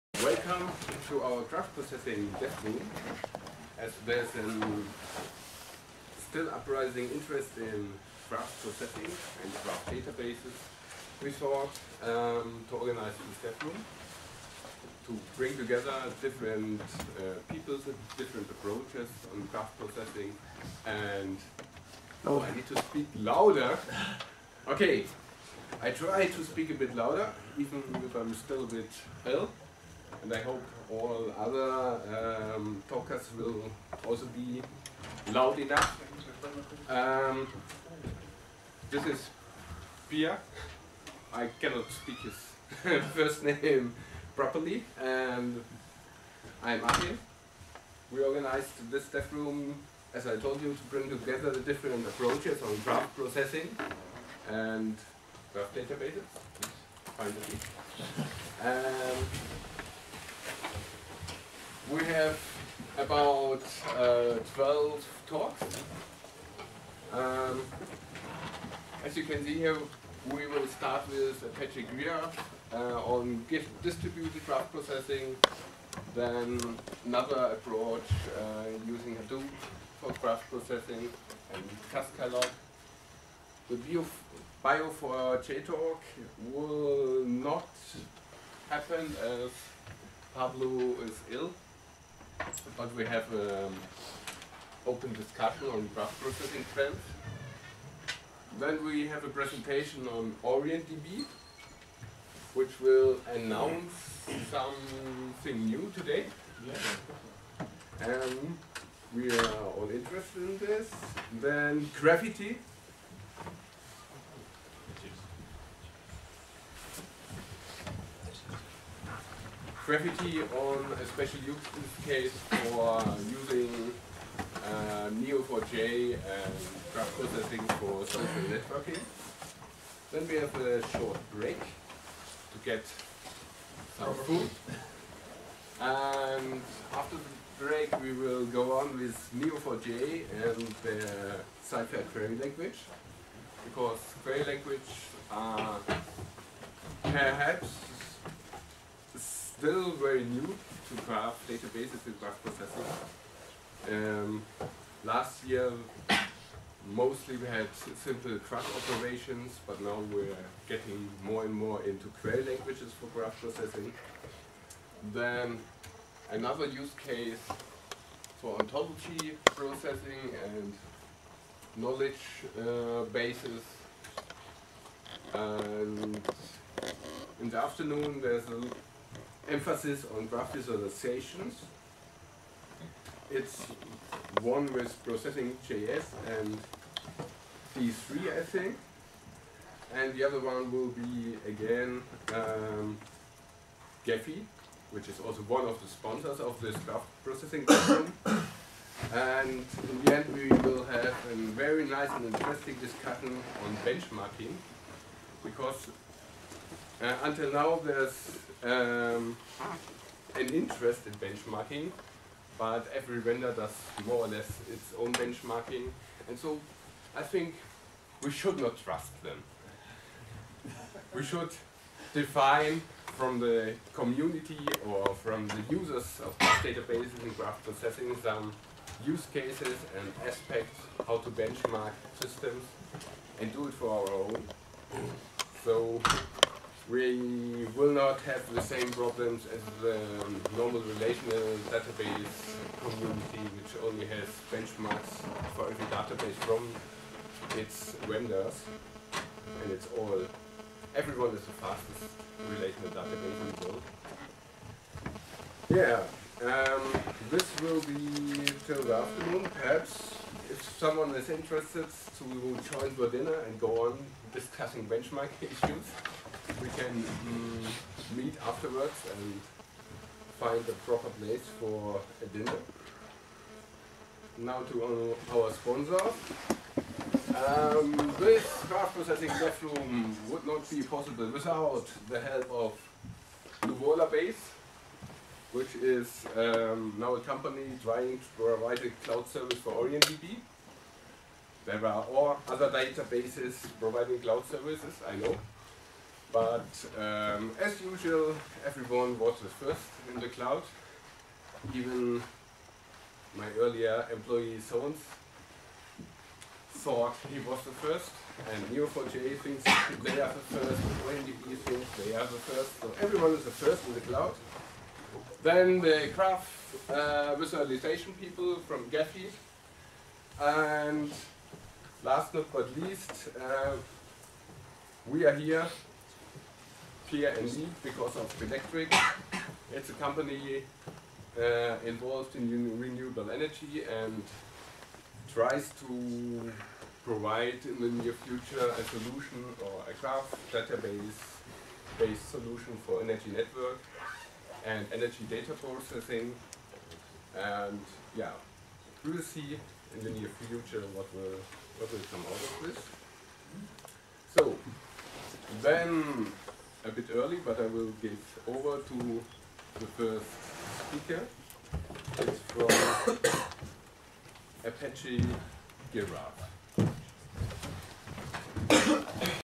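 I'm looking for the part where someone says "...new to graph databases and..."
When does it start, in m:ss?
2:30.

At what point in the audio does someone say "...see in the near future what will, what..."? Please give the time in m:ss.
5:49.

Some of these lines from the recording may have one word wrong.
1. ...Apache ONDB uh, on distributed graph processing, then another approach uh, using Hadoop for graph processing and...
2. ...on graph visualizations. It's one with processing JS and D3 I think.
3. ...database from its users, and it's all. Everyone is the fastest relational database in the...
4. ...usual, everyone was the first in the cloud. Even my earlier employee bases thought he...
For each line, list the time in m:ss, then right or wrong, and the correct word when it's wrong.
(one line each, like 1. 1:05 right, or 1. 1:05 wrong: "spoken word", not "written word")
1. 1:11 wrong: "Giraph", not "ONDB"
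2. 3:00 right
3. 4:05 wrong: "vendors", not "users"
4. 4:57 wrong: "sones", not "bases".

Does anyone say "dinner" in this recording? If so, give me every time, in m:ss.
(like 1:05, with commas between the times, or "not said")
4:23, 4:32.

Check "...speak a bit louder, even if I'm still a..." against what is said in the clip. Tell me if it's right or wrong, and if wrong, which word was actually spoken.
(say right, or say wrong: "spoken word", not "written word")
right.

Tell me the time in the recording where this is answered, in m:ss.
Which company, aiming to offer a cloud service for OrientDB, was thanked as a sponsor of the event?
4:43.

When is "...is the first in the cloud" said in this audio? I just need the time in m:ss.
5:13.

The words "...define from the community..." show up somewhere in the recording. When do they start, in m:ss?
3:42.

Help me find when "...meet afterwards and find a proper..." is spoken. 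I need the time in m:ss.
4:28.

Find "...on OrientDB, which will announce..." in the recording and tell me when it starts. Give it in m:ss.
1:40.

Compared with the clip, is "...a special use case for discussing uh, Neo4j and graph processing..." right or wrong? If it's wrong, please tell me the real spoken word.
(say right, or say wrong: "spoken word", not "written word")
wrong: "using", not "discussing".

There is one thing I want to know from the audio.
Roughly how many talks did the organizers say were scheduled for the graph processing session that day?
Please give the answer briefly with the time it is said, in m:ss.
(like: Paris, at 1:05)
12, at 1:04.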